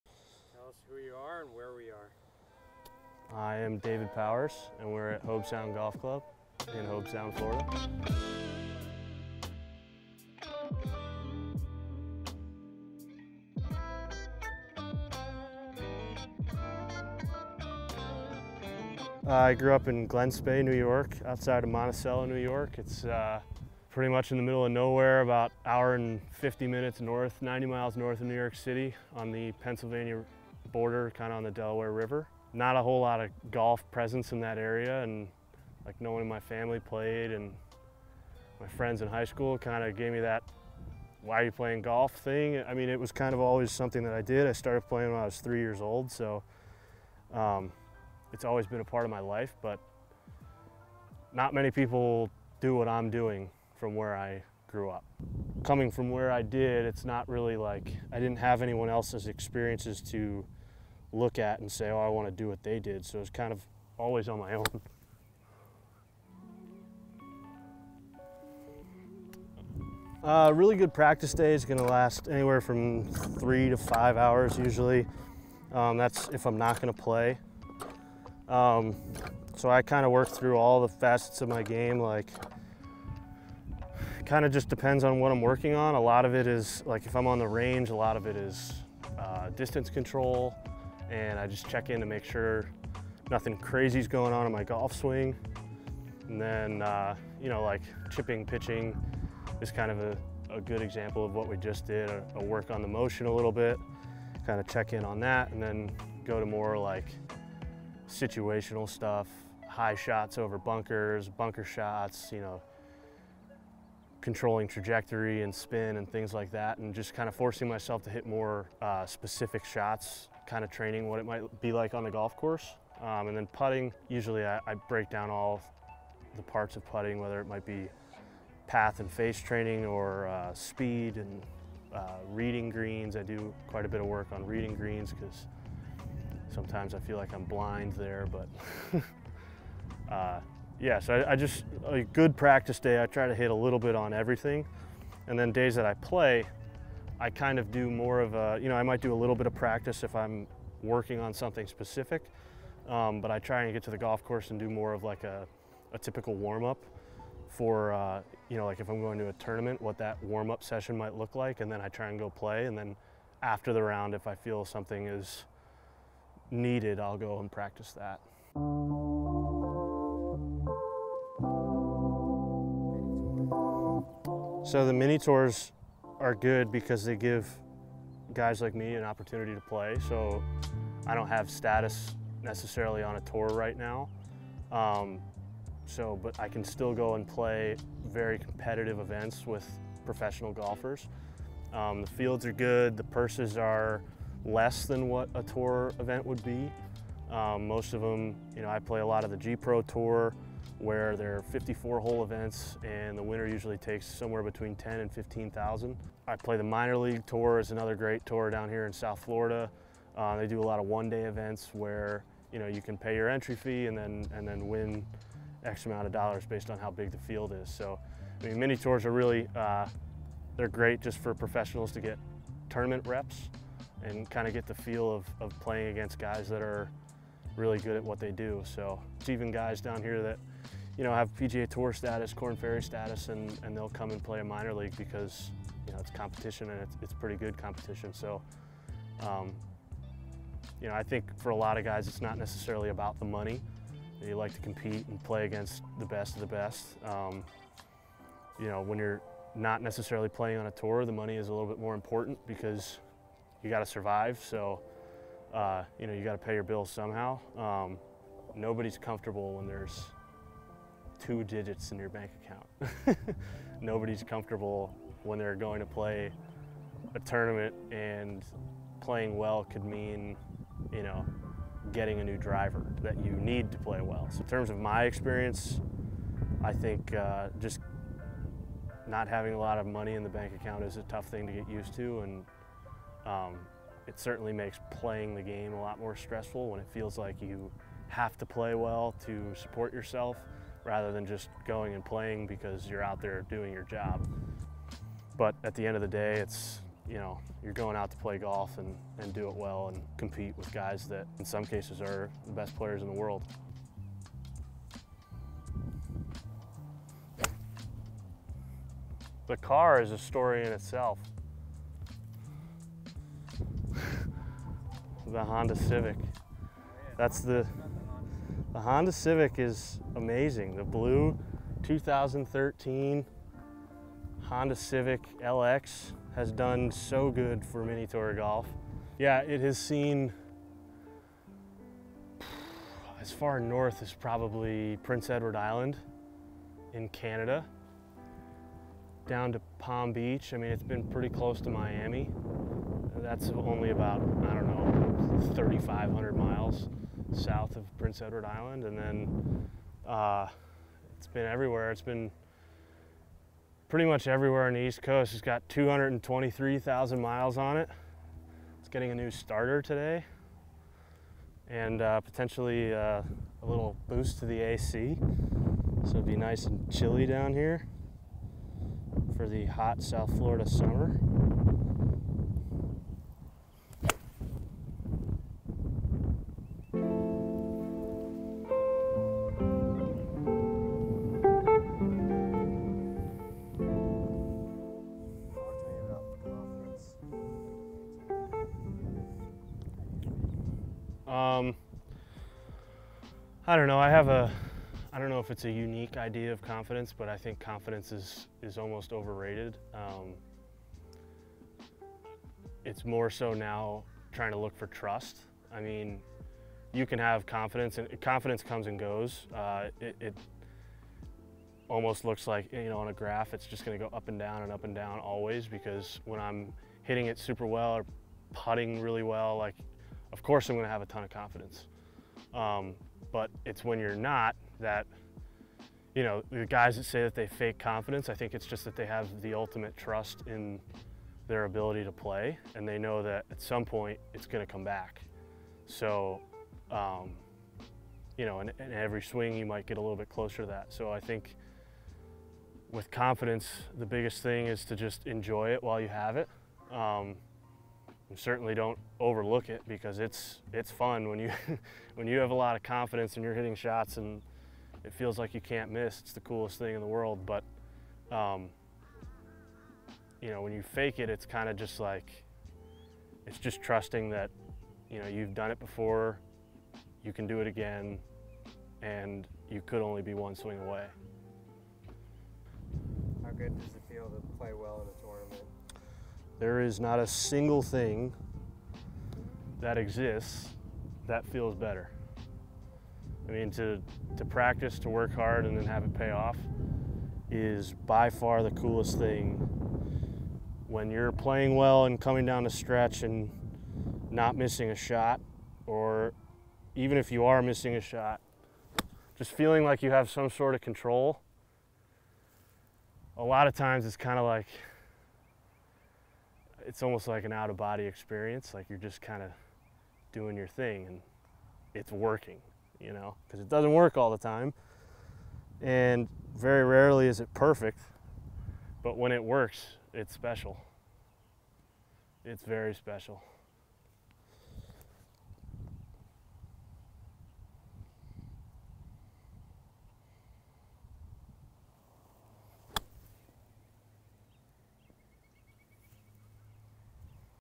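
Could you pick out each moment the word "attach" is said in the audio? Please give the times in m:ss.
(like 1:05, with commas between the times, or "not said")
not said.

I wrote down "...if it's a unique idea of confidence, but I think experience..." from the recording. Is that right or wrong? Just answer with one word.
wrong.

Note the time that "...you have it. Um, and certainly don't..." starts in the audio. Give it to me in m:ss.
7:26.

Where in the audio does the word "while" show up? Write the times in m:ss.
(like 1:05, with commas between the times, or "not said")
7:25.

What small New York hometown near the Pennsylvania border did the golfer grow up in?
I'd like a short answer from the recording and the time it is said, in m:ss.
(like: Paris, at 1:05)
Glen Spey, at 0:20.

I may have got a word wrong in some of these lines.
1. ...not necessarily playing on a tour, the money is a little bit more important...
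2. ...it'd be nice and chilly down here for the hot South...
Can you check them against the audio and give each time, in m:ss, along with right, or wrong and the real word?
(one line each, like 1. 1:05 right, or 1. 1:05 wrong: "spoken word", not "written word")
1. 4:09 right
2. 6:06 right.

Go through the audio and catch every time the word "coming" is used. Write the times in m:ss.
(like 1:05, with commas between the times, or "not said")
0:55, 8:12.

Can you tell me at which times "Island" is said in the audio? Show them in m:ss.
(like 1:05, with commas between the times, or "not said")
5:35, 5:48.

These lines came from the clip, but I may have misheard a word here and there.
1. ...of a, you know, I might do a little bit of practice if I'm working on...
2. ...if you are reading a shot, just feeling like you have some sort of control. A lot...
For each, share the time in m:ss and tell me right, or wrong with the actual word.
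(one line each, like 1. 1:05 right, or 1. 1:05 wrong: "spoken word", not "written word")
1. 2:28 right
2. 8:17 wrong: "missing", not "reading".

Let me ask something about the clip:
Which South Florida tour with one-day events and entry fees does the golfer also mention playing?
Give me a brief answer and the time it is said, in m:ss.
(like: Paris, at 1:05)
minor league tour, at 3:26.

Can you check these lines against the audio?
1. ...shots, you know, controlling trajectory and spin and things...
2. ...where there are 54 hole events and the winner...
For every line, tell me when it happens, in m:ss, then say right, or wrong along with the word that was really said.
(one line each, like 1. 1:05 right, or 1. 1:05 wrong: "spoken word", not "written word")
1. 1:51 right
2. 3:20 right.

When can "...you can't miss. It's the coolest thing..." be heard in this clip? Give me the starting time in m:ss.
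7:35.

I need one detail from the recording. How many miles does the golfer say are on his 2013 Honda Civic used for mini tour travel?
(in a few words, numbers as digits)
223,000.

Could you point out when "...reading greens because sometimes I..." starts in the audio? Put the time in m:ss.
2:14.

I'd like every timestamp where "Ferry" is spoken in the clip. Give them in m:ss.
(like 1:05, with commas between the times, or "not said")
3:52.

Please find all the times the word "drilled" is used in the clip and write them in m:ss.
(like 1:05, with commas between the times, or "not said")
not said.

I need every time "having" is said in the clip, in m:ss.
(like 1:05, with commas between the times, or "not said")
4:39.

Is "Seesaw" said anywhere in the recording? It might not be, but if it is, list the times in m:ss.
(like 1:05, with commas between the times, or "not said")
not said.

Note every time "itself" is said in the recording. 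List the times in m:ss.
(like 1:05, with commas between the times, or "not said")
5:10.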